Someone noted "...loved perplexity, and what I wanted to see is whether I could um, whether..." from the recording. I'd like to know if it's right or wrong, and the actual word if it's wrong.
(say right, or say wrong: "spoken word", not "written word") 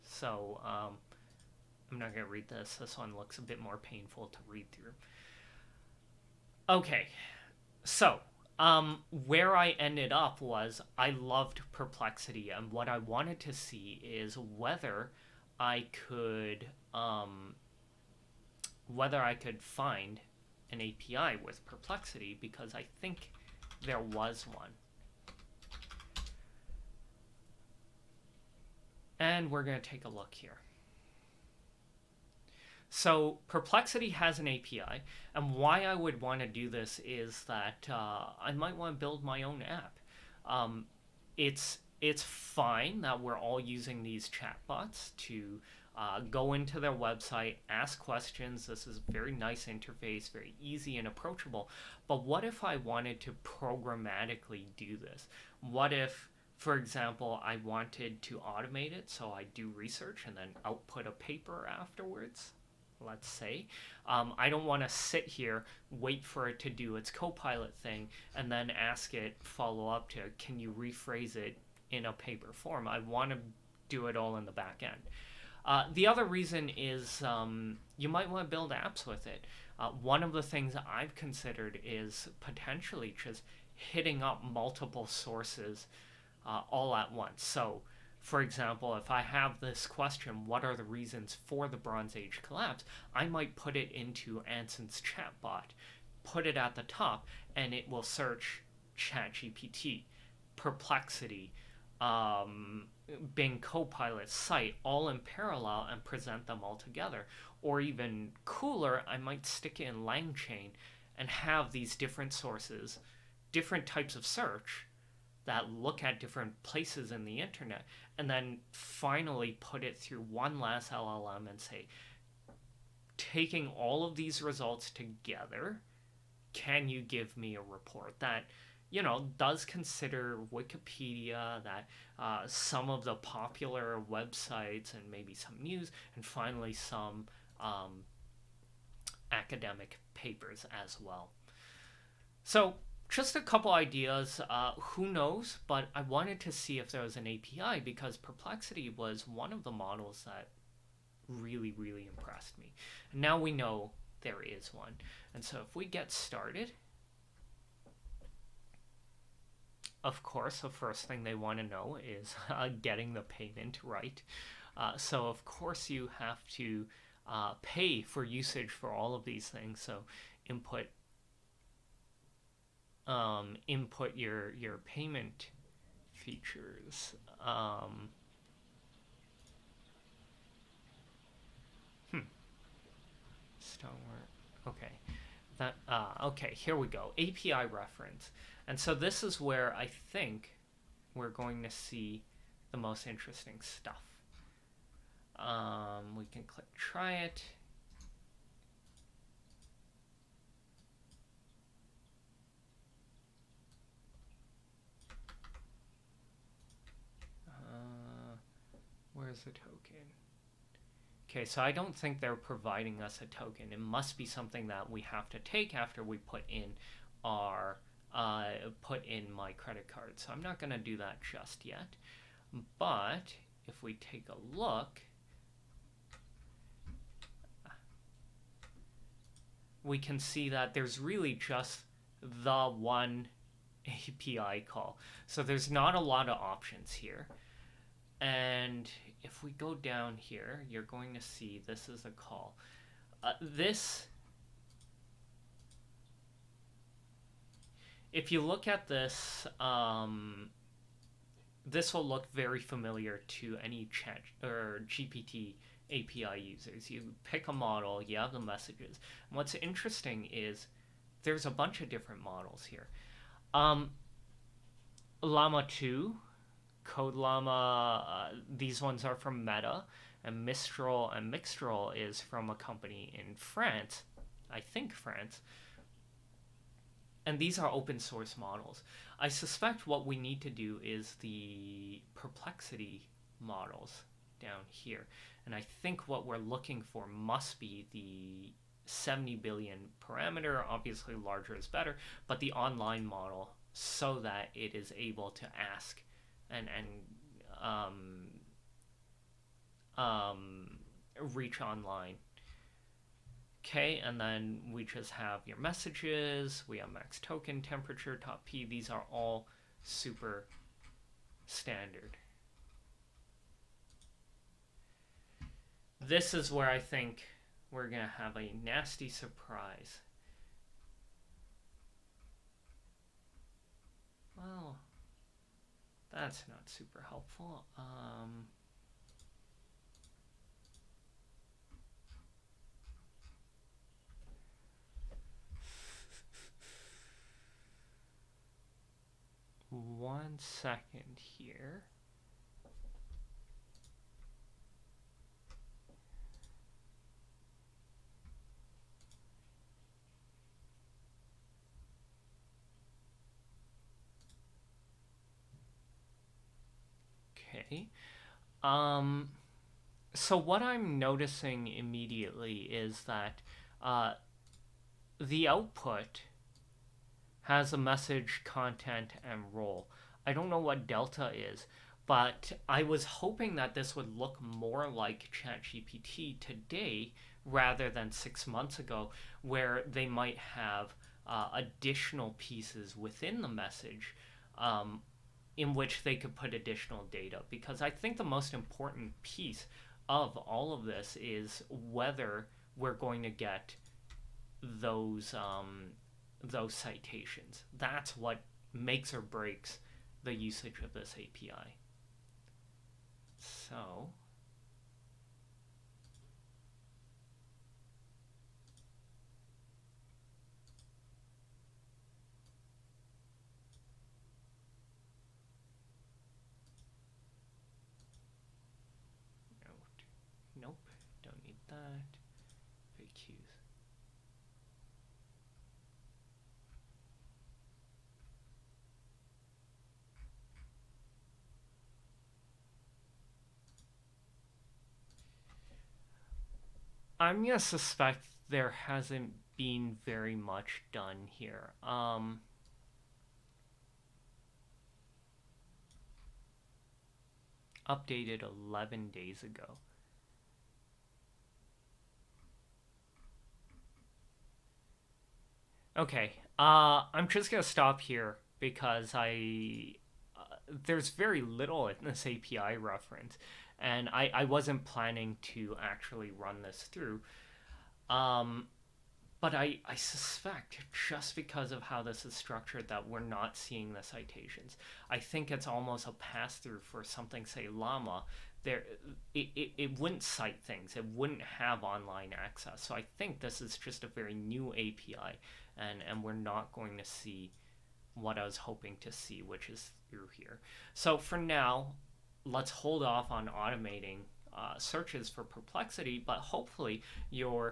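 right.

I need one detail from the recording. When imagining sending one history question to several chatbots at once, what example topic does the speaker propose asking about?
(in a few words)
Bronze Age collapse.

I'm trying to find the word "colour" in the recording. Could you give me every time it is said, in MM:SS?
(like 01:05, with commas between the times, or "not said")
not said.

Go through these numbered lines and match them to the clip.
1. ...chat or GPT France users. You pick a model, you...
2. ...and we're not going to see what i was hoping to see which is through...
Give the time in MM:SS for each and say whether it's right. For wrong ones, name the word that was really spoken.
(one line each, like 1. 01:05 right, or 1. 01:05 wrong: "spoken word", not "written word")
1. 04:13 wrong: "API", not "France"
2. 08:06 right.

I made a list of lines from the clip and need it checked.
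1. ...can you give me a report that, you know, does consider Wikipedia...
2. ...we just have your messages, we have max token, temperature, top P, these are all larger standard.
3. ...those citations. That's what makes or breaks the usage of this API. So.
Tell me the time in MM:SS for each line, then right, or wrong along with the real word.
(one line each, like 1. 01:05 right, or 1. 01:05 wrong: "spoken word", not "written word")
1. 02:06 right
2. 05:04 wrong: "super", not "larger"
3. 06:36 right.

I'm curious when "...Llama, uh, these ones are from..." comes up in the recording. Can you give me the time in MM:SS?
04:27.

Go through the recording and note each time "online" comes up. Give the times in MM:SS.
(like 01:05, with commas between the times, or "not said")
04:52, 05:01, 08:01.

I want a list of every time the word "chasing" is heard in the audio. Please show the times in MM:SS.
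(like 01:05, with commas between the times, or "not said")
not said.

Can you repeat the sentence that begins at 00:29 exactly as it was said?
And we're going to take a look here.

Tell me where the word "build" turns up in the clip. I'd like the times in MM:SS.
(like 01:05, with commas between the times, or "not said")
00:39, 01:18.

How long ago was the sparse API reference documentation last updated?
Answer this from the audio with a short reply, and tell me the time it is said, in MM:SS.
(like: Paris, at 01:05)
11 days ago, at 07:28.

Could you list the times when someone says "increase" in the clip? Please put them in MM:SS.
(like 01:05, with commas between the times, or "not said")
not said.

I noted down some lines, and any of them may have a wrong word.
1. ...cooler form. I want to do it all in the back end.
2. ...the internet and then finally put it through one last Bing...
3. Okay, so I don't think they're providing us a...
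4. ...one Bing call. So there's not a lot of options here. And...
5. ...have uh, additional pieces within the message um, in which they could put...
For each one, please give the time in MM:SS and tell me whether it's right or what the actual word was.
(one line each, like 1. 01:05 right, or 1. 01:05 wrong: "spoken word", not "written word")
1. 01:12 wrong: "paper", not "cooler"
2. 01:57 wrong: "LLM", not "Bing"
3. 03:31 right
4. 03:52 wrong: "API", not "Bing"
5. 06:20 right.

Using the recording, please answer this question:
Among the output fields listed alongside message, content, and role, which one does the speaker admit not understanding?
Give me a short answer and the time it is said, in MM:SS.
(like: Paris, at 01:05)
delta, at 06:10.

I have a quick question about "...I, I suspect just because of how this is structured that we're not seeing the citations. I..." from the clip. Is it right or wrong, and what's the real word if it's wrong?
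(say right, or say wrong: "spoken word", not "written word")
right.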